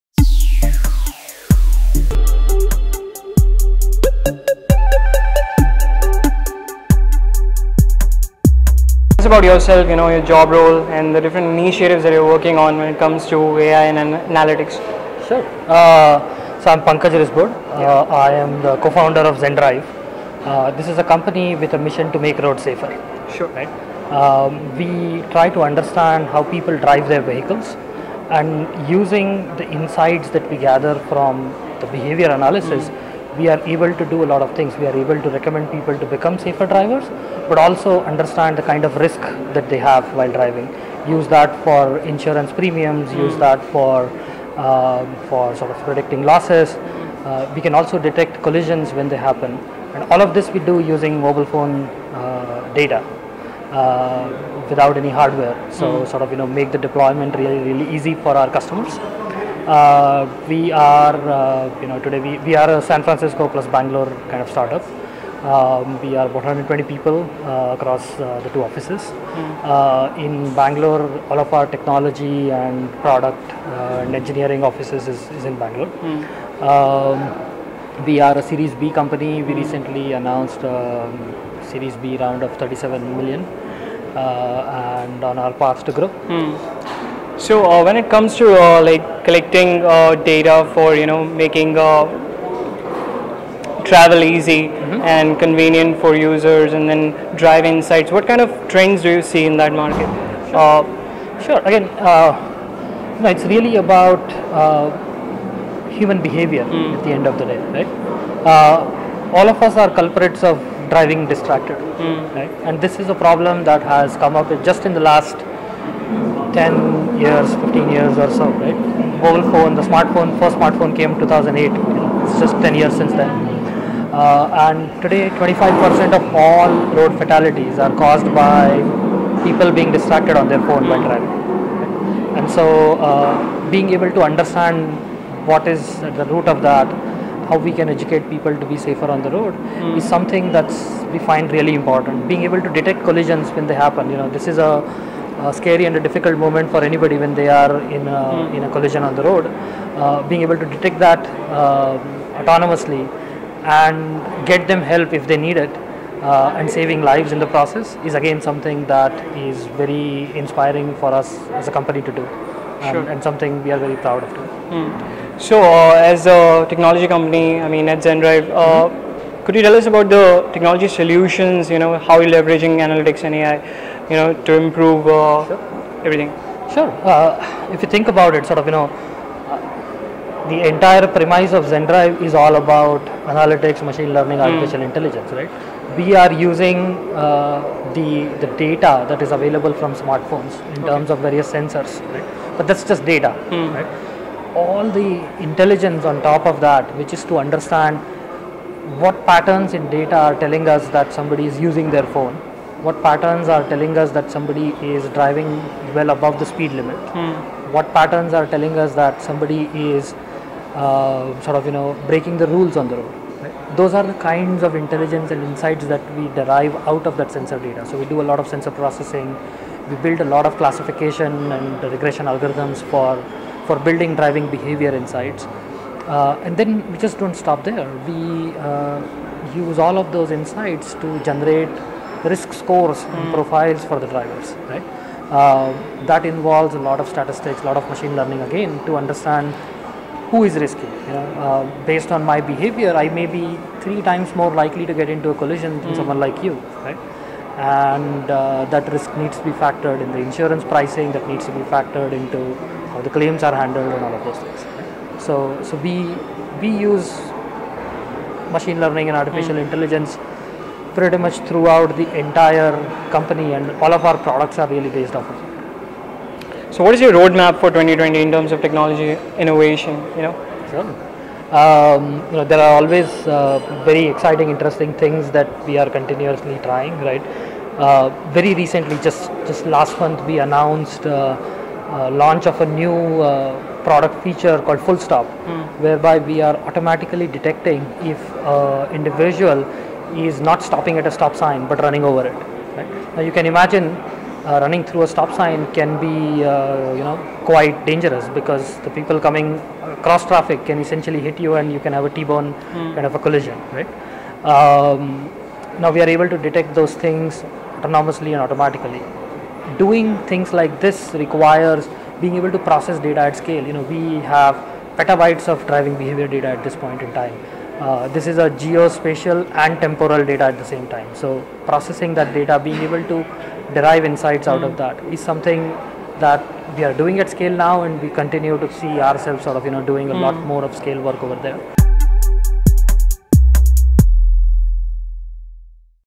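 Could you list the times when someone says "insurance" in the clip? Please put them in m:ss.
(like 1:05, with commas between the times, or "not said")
0:41, 4:10.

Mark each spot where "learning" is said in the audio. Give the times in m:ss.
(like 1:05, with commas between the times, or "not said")
3:04, 3:58, 4:18.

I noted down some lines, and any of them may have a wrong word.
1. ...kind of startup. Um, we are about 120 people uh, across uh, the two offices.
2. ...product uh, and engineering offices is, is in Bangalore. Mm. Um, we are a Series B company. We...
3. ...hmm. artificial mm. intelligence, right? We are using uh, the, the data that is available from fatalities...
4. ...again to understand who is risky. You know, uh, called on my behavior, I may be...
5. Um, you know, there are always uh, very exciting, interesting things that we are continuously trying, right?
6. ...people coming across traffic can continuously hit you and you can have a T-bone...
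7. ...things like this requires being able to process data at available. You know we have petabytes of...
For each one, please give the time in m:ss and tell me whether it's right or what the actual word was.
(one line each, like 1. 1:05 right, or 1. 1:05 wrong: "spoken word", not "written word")
1. 1:04 right
2. 1:13 right
3. 3:04 wrong: "smartphones", not "fatalities"
4. 3:58 wrong: "based", not "called"
5. 4:31 right
6. 4:58 wrong: "essentially", not "continuously"
7. 5:10 wrong: "scale", not "available".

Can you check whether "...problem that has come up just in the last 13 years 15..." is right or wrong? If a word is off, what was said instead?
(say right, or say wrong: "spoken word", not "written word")
wrong: "10", not "13".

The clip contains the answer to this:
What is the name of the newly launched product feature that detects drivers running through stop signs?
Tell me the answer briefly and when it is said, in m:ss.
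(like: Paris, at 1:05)
full stop, at 4:44.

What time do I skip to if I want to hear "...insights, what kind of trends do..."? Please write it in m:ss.
1:37.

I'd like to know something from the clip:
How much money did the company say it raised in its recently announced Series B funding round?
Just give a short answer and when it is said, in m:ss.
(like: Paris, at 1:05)
37 million, at 1:22.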